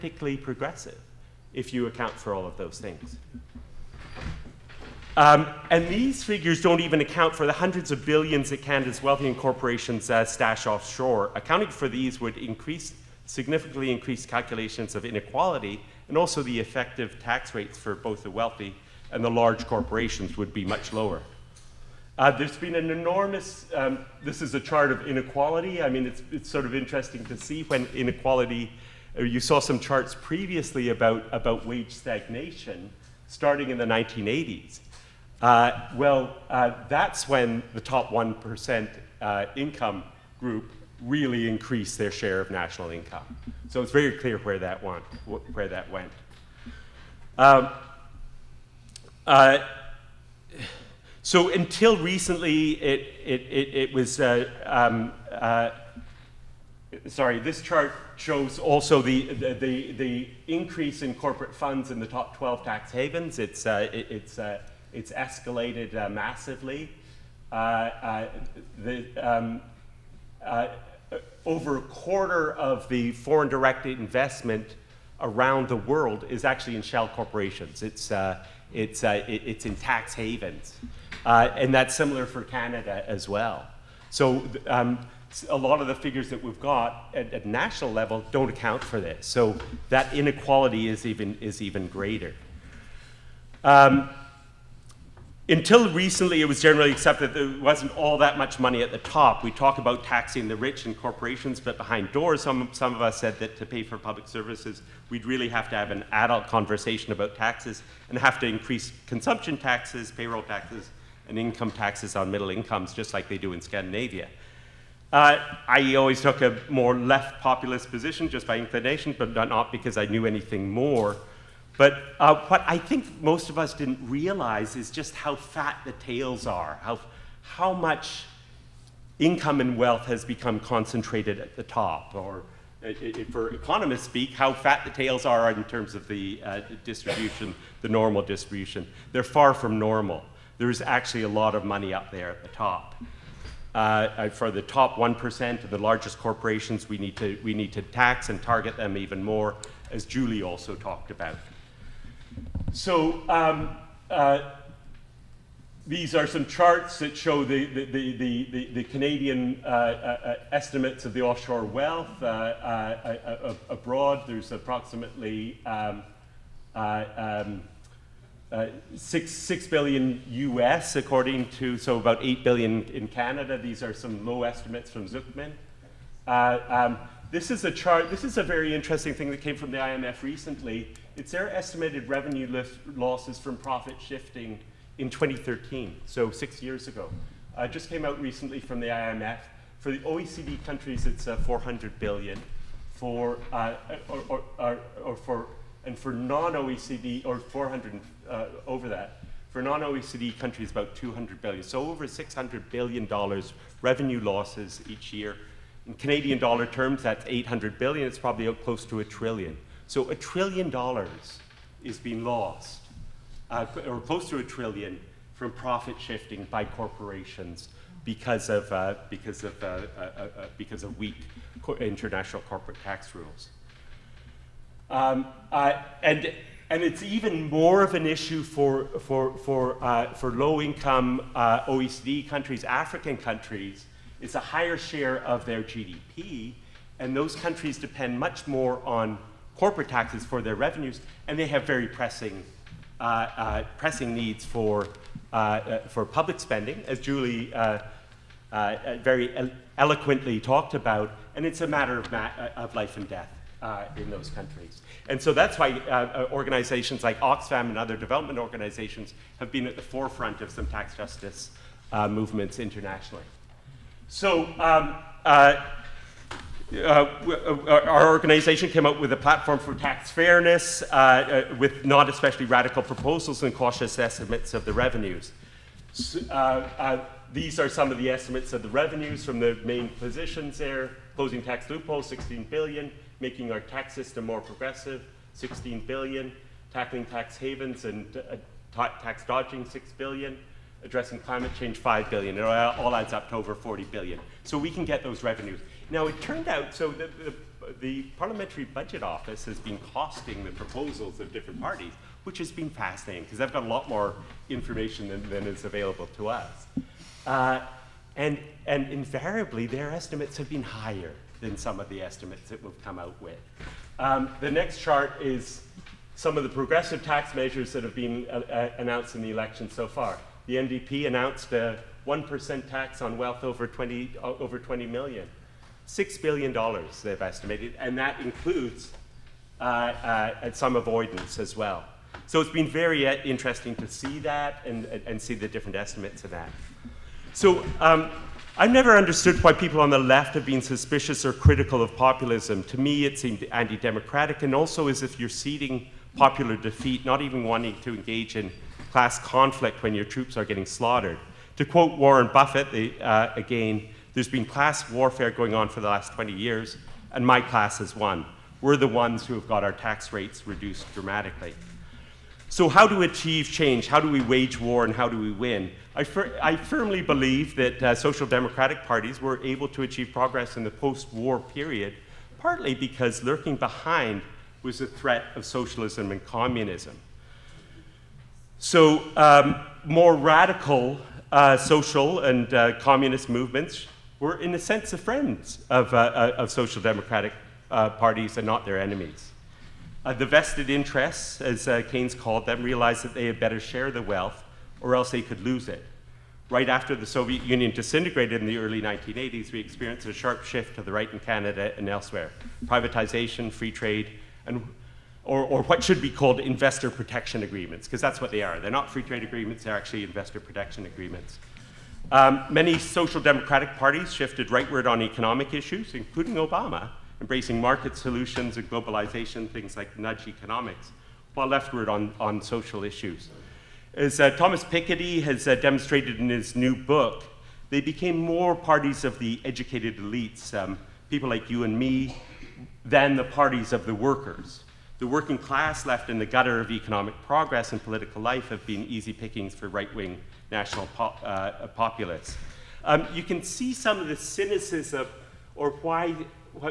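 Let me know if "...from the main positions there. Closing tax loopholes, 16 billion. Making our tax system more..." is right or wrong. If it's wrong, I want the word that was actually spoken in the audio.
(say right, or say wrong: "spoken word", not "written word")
right.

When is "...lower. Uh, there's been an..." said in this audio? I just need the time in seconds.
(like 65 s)
20 s.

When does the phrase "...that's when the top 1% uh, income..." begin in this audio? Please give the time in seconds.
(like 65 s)
36 s.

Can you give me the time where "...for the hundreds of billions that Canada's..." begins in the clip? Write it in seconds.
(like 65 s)
7 s.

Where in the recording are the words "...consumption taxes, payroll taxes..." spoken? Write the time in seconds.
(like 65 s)
109 s.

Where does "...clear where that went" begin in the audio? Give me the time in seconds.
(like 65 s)
44 s.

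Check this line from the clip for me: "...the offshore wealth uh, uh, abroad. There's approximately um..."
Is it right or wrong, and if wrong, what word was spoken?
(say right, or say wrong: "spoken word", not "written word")
right.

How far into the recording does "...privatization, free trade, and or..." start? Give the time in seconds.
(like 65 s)
402 s.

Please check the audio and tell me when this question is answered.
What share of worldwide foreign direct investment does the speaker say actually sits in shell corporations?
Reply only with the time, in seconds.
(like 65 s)
71 s.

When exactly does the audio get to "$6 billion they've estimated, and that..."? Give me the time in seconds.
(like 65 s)
325 s.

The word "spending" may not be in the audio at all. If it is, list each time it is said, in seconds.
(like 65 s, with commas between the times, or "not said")
246 s.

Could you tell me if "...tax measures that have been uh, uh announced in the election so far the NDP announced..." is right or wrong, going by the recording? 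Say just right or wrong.
right.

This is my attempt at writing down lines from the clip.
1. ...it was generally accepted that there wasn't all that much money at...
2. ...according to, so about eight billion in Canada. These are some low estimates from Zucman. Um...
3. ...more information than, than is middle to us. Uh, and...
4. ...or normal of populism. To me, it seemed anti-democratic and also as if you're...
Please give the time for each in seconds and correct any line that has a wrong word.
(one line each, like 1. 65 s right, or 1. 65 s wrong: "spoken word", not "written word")
1. 96 s right
2. 170 s right
3. 303 s wrong: "available", not "middle"
4. 341 s wrong: "critical", not "normal".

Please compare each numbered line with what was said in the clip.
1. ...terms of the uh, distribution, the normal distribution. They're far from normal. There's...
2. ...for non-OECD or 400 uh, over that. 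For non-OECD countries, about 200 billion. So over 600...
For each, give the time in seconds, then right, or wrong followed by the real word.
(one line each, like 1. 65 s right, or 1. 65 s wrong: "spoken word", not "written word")
1. 135 s right
2. 195 s right.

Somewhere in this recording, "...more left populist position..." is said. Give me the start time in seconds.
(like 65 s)
116 s.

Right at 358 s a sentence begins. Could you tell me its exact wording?
We're the ones who have got our tax rates reduced dramatically.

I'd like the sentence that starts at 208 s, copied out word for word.
It's probably close to a trillion.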